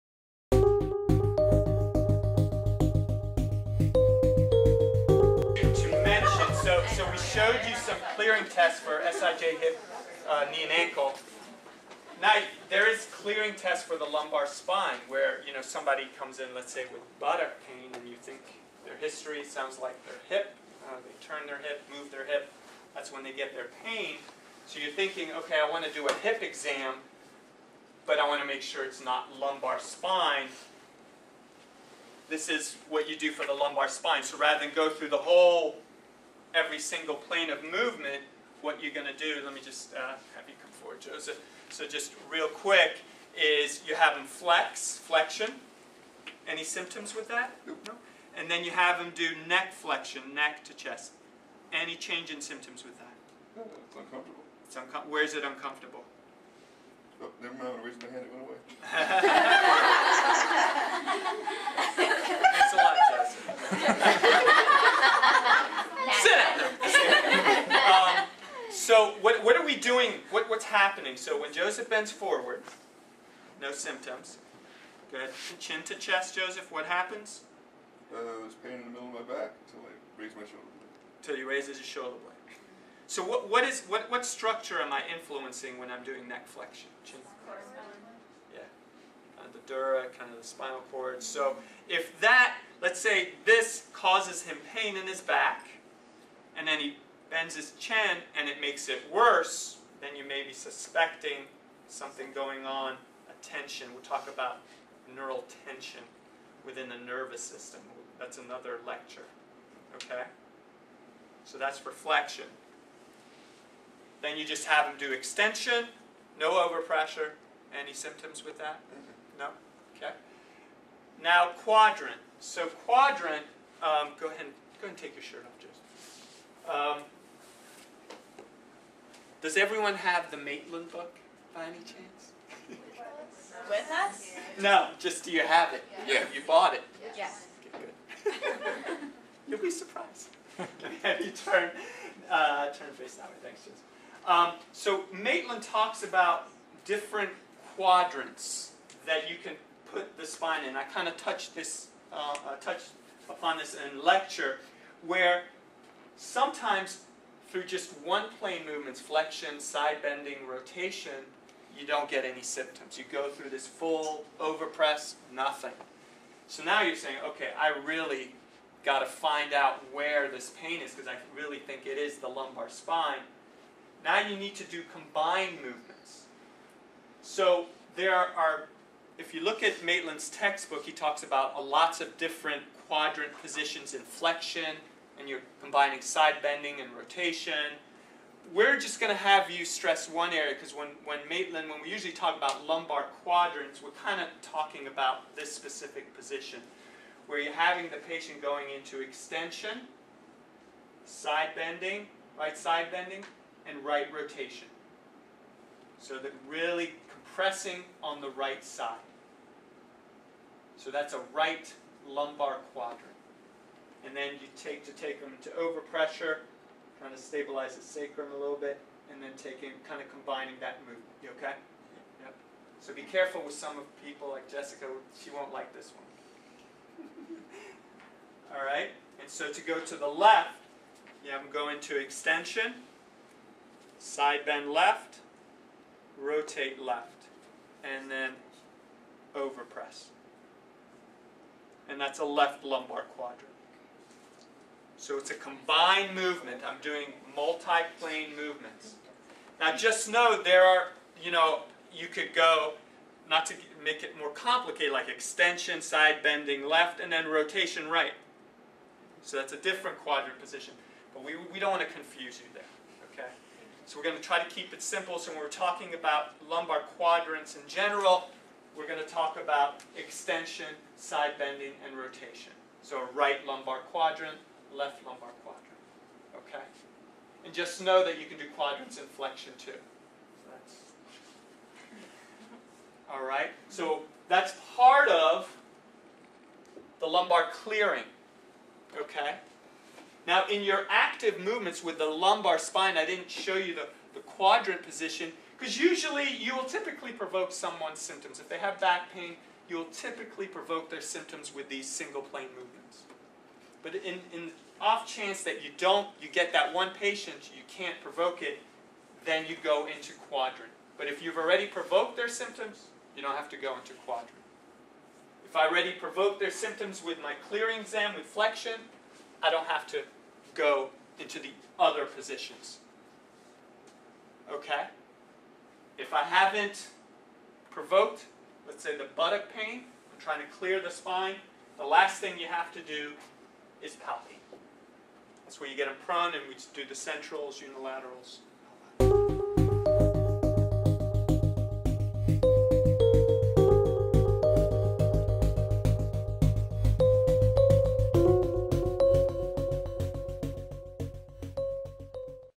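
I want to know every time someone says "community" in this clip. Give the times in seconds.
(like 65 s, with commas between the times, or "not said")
not said.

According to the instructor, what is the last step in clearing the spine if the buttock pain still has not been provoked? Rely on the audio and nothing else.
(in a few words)
Palpate.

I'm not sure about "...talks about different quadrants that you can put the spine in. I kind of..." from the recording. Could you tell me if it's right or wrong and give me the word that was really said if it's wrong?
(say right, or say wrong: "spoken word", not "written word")
right.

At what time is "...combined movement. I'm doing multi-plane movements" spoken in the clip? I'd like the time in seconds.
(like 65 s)
245 s.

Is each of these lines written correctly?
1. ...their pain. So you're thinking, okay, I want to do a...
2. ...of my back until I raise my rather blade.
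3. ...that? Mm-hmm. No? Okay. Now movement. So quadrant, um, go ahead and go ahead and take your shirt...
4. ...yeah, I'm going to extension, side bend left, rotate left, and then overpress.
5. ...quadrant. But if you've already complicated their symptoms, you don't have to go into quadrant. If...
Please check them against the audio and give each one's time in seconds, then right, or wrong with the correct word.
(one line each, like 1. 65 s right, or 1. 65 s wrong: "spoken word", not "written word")
1. 23 s right
2. 79 s wrong: "shoulder", not "rather"
3. 118 s wrong: "quadrant", not "movement"
4. 231 s right
5. 310 s wrong: "provoked", not "complicated".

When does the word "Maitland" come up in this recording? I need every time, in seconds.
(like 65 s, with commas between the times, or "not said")
130 s, 145 s, 179 s, 191 s.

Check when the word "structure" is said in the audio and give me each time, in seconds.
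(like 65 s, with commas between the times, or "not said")
84 s.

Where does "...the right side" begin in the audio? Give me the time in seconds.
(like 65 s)
208 s.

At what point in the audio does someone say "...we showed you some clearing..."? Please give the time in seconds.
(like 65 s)
7 s.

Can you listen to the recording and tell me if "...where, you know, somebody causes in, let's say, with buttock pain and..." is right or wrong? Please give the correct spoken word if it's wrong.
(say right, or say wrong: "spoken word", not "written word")
wrong: "comes", not "causes".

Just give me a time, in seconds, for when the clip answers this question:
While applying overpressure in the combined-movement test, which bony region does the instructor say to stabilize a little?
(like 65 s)
217 s.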